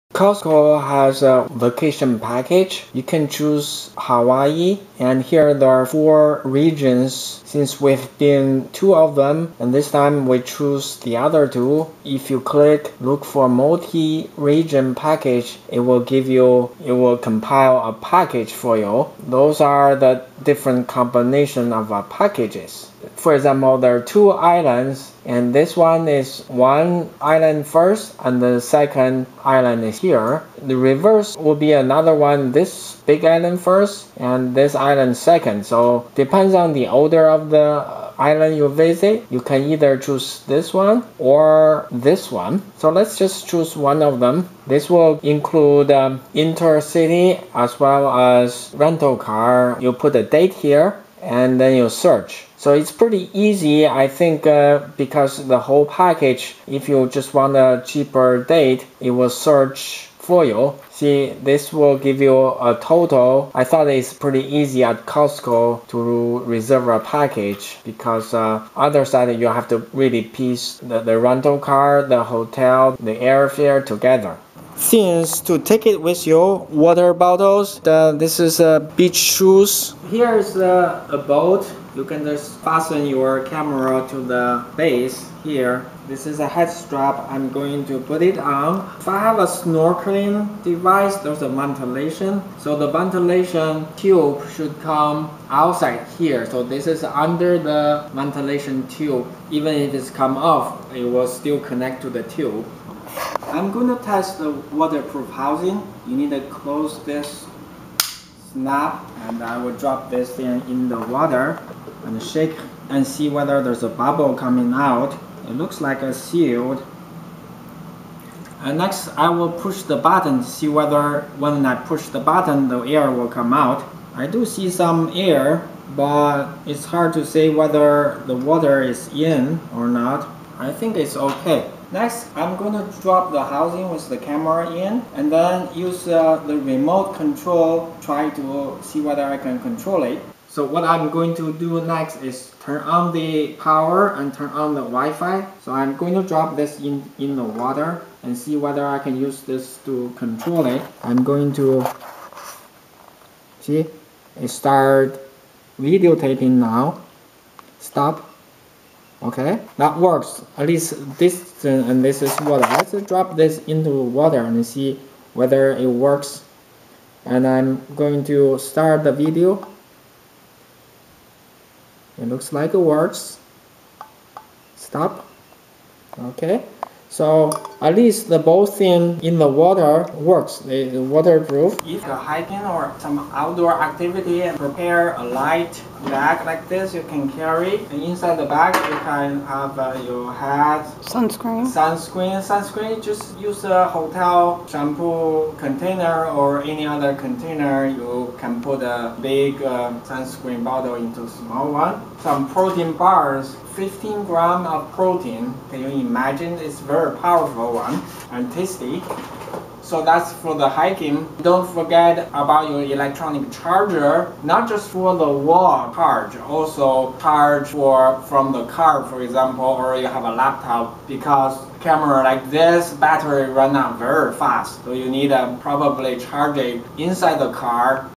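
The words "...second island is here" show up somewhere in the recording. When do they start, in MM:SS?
00:28.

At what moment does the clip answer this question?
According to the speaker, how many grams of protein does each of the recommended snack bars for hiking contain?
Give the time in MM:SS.
03:23.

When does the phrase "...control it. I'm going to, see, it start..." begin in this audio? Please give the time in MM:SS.
02:30.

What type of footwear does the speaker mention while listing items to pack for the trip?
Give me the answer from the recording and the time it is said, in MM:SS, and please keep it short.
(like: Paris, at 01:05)
Beach shoes, at 01:18.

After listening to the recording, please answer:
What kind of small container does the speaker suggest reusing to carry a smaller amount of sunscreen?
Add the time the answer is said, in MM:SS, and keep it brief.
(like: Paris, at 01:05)
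Hotel shampoo container, at 03:13.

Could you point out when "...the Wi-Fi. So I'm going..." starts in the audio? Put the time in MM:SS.
02:24.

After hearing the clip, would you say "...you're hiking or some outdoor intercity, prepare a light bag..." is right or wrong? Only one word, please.
wrong.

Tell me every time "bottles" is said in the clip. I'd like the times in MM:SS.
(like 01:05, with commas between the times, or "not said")
01:17, 03:20.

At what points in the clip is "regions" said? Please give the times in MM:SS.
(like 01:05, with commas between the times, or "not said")
00:06, 00:13.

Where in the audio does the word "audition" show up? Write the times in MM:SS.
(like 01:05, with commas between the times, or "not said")
not said.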